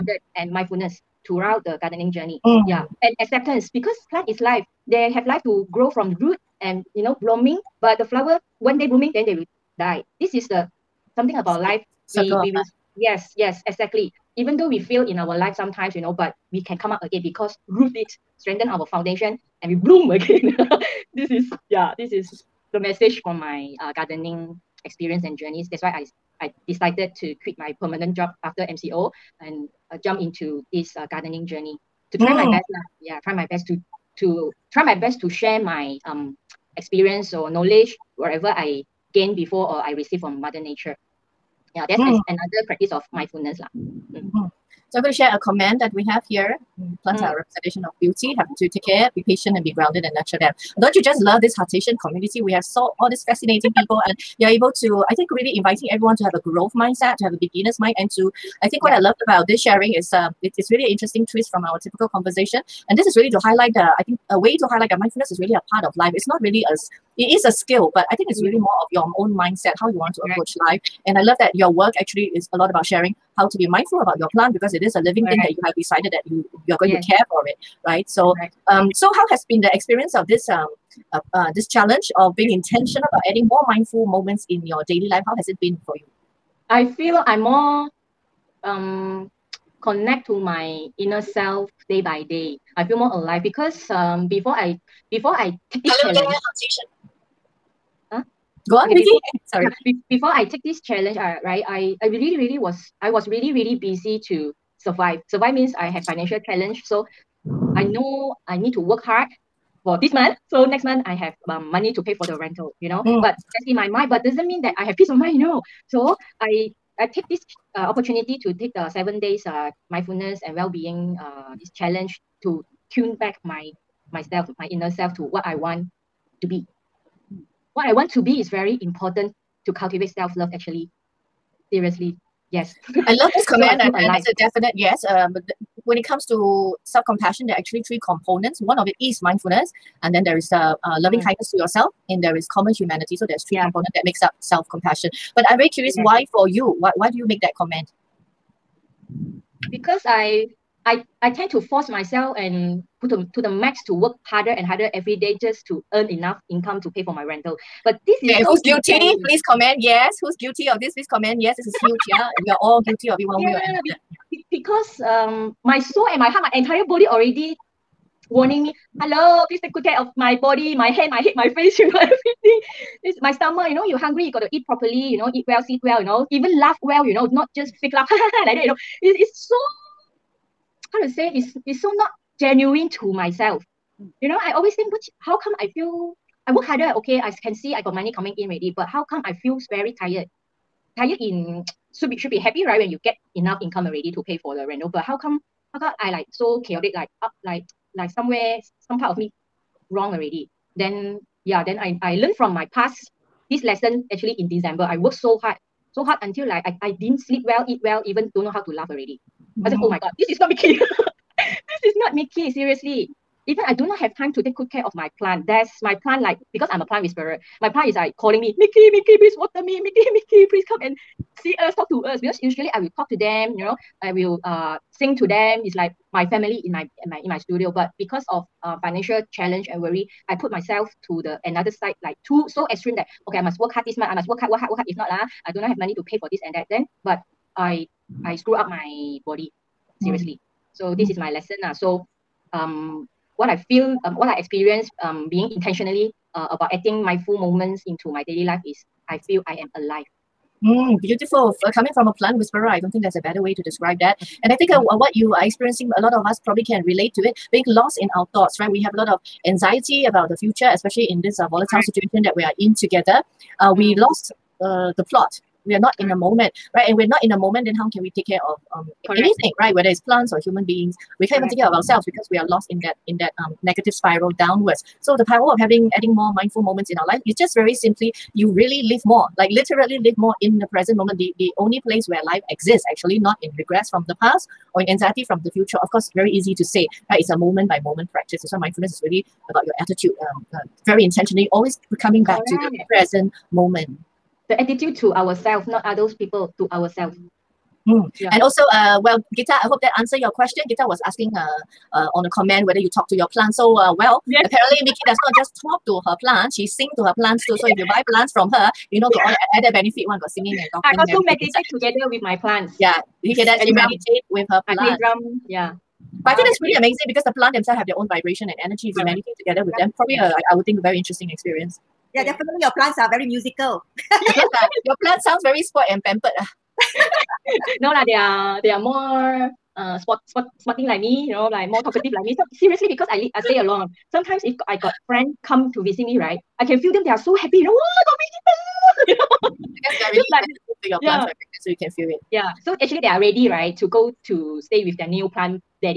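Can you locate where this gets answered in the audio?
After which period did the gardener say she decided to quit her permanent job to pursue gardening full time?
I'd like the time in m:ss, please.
0:28.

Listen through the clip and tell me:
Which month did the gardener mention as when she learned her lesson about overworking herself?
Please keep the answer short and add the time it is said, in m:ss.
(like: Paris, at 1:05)
December, at 3:24.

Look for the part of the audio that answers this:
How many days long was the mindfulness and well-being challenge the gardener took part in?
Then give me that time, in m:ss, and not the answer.
1:58.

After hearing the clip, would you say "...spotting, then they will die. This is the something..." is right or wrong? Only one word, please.
wrong.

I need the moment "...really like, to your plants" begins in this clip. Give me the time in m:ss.
5:40.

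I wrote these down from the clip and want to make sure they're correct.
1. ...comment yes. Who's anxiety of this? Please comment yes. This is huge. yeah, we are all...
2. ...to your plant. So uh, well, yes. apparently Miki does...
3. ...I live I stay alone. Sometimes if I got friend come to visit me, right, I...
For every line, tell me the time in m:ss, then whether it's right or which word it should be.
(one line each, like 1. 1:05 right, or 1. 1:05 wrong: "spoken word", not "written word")
1. 2:39 wrong: "guilty", not "anxiety"
2. 5:03 right
3. 5:33 right.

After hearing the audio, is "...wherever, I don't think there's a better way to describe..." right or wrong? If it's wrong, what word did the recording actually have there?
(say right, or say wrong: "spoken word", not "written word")
wrong: "whisperer", not "wherever".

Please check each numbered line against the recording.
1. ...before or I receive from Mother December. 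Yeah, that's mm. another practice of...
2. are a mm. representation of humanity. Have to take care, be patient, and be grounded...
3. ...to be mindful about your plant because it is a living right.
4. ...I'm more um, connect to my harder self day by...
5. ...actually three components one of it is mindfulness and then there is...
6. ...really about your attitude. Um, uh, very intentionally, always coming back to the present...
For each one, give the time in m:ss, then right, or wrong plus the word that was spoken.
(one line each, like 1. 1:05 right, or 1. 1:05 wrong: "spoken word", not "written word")
1. 0:39 wrong: "Nature", not "December"
2. 0:47 wrong: "beauty", not "humanity"
3. 1:13 right
4. 1:27 wrong: "inner", not "harder"
5. 2:17 right
6. 4:49 right.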